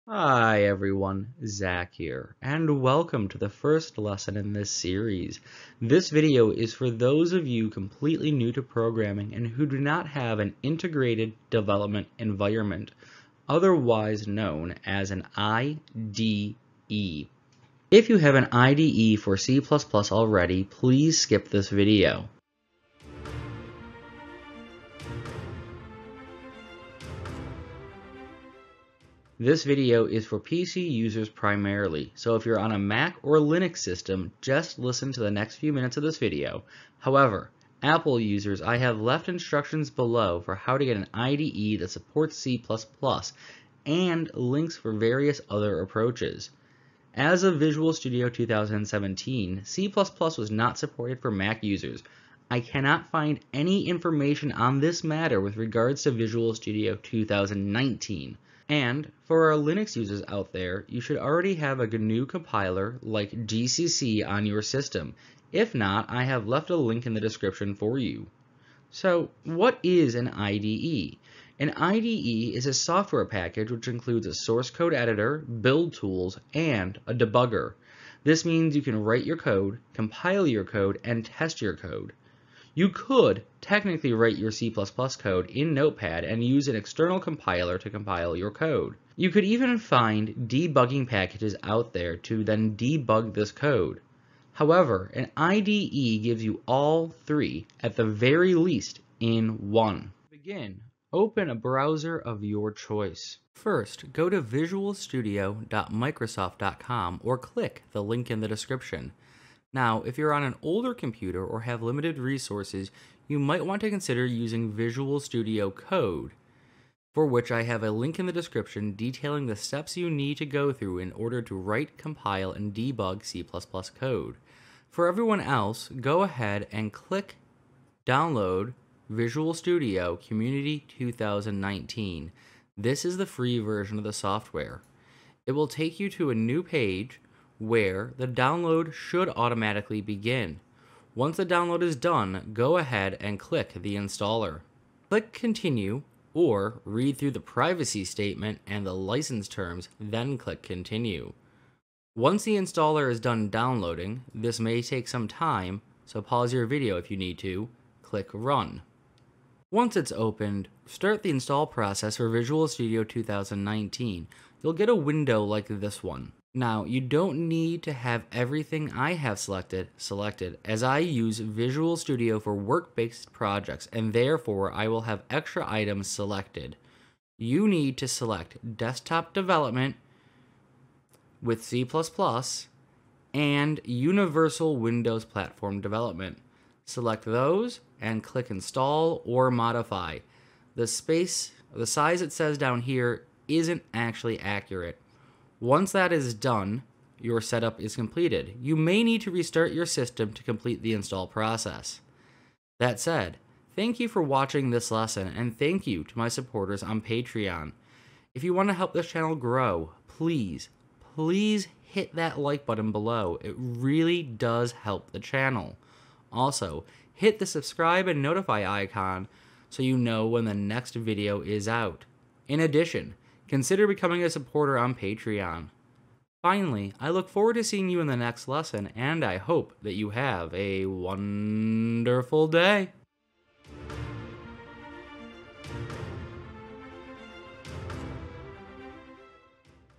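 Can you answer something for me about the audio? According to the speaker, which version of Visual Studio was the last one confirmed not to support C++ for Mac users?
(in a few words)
Visual Studio 2017.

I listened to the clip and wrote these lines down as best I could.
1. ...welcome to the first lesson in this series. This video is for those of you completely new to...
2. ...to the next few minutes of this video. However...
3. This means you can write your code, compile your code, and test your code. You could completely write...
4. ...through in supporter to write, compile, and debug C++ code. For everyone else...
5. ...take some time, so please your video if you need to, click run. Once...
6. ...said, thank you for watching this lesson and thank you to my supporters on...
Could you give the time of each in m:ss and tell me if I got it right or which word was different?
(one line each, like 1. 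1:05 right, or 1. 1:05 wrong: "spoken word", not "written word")
1. 0:02 right
2. 0:35 right
3. 1:18 wrong: "technically", not "completely"
4. 2:00 wrong: "order", not "supporter"
5. 2:34 wrong: "pause", not "please"
6. 3:22 right.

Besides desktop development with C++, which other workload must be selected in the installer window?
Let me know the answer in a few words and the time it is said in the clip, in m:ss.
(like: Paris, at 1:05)
Universal Windows platform development, at 3:03.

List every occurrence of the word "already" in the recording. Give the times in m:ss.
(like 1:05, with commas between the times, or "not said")
0:19, 1:01.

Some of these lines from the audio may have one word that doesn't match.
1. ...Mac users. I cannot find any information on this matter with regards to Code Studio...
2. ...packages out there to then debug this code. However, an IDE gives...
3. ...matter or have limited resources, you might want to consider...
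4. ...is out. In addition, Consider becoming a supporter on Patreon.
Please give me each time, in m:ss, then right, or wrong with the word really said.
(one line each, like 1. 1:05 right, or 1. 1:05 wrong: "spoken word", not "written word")
1. 0:51 wrong: "Visual", not "Code"
2. 1:31 right
3. 1:50 wrong: "computer", not "matter"
4. 3:41 right.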